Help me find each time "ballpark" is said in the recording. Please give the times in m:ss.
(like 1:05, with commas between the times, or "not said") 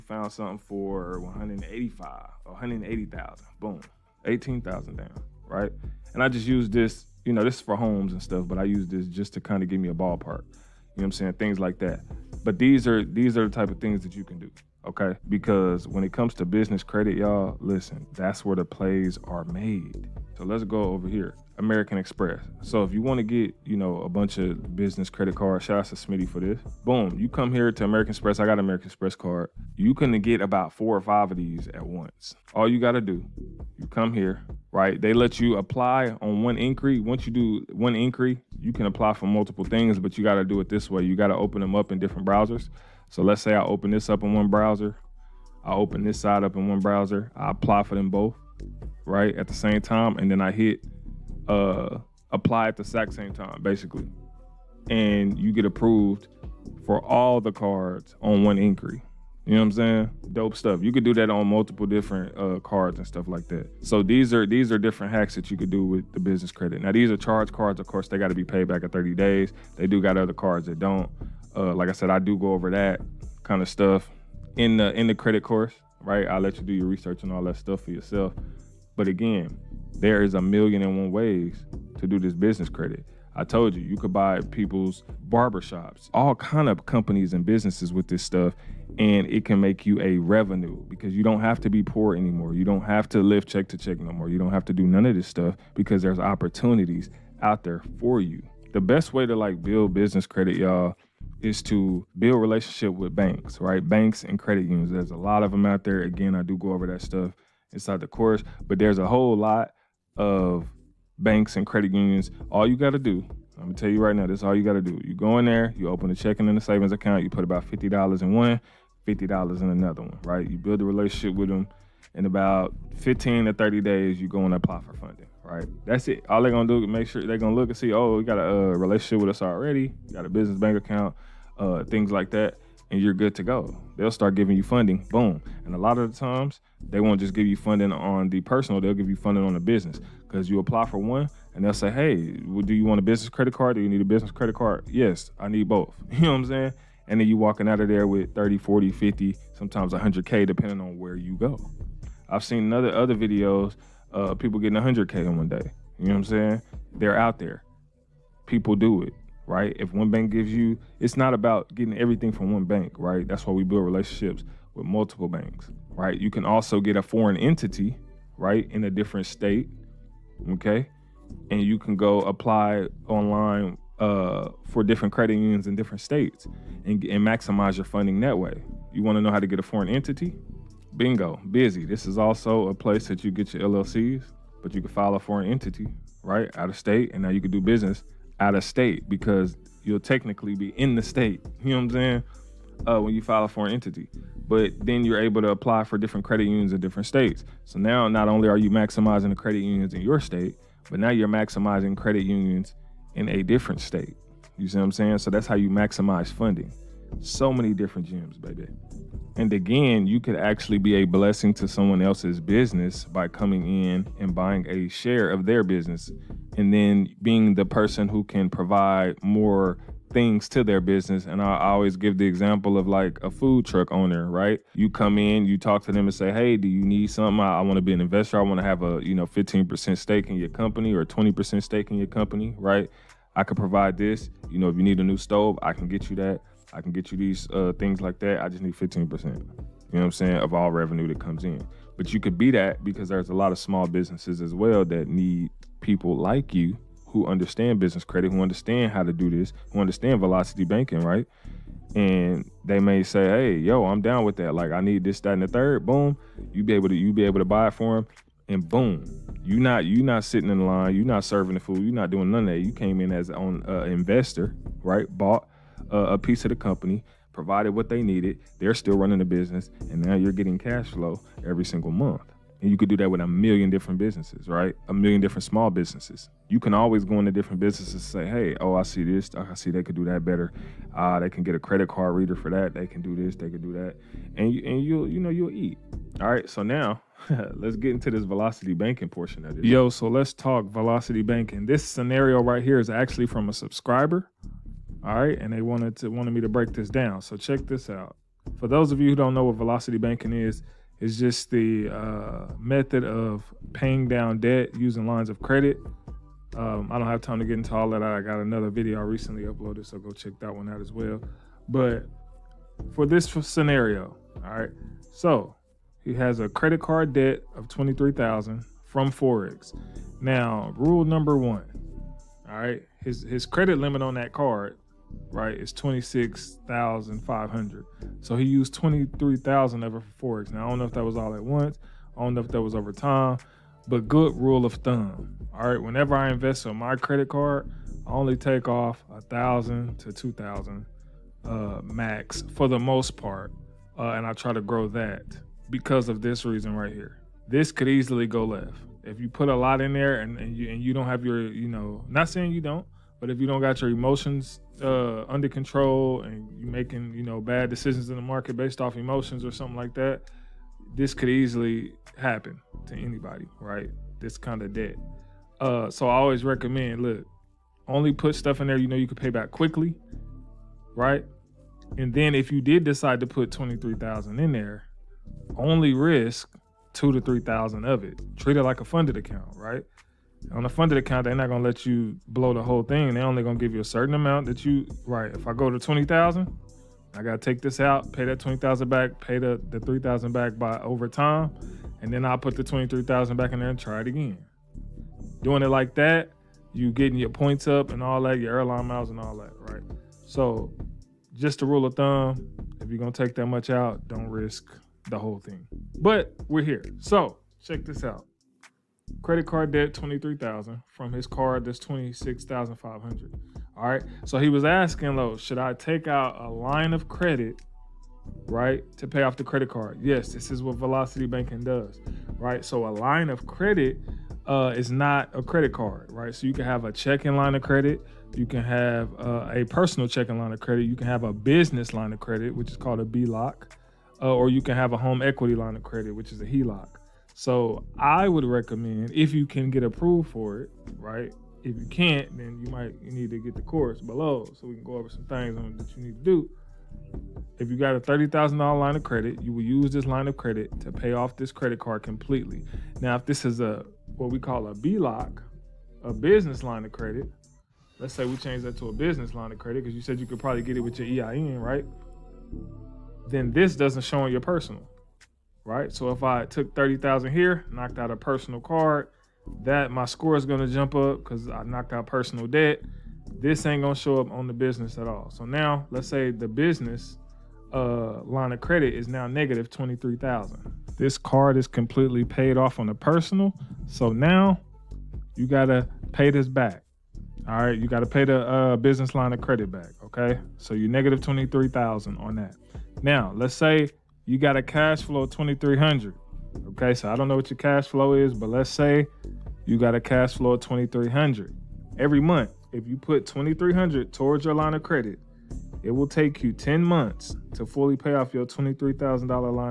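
0:09.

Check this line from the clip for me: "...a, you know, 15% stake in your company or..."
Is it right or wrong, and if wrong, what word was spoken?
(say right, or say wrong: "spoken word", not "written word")
right.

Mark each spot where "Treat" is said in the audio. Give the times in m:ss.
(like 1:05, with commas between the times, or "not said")
6:18.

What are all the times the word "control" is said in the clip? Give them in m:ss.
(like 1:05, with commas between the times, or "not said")
5:55.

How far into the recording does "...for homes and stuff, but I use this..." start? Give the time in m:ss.
0:07.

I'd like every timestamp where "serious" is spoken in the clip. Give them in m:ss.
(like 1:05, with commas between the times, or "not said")
not said.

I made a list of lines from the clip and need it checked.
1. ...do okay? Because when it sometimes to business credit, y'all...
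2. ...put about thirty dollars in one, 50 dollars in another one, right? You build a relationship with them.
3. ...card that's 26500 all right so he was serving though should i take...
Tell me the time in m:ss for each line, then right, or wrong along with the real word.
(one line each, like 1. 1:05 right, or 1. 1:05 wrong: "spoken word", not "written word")
1. 0:14 wrong: "comes", not "sometimes"
2. 1:57 wrong: "fifty", not "thirty"
3. 6:51 wrong: "asking", not "serving".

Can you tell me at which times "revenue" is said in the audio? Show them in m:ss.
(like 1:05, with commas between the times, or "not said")
1:30, 4:00.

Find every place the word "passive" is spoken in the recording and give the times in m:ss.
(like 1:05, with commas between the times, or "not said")
not said.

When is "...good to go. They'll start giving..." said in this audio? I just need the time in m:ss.
2:13.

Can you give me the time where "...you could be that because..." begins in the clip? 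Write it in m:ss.
4:02.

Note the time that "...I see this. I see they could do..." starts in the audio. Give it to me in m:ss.
4:38.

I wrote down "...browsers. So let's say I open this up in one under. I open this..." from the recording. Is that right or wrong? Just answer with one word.
wrong.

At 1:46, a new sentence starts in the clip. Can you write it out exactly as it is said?
Again, I do go over that stuff inside the course, but there's a whole lot of banks and credit unions.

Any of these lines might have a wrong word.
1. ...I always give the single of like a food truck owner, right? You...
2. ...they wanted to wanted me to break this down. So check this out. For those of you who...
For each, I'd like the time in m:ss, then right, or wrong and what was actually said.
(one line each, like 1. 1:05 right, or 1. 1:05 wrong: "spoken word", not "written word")
1. 3:41 wrong: "example", not "single"
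2. 4:55 right.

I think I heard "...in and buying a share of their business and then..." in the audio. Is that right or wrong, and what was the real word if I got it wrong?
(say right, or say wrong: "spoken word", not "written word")
right.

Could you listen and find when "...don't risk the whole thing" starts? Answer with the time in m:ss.
6:44.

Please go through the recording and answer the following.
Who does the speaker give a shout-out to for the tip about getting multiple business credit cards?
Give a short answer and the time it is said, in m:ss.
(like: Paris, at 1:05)
Smitty, at 0:25.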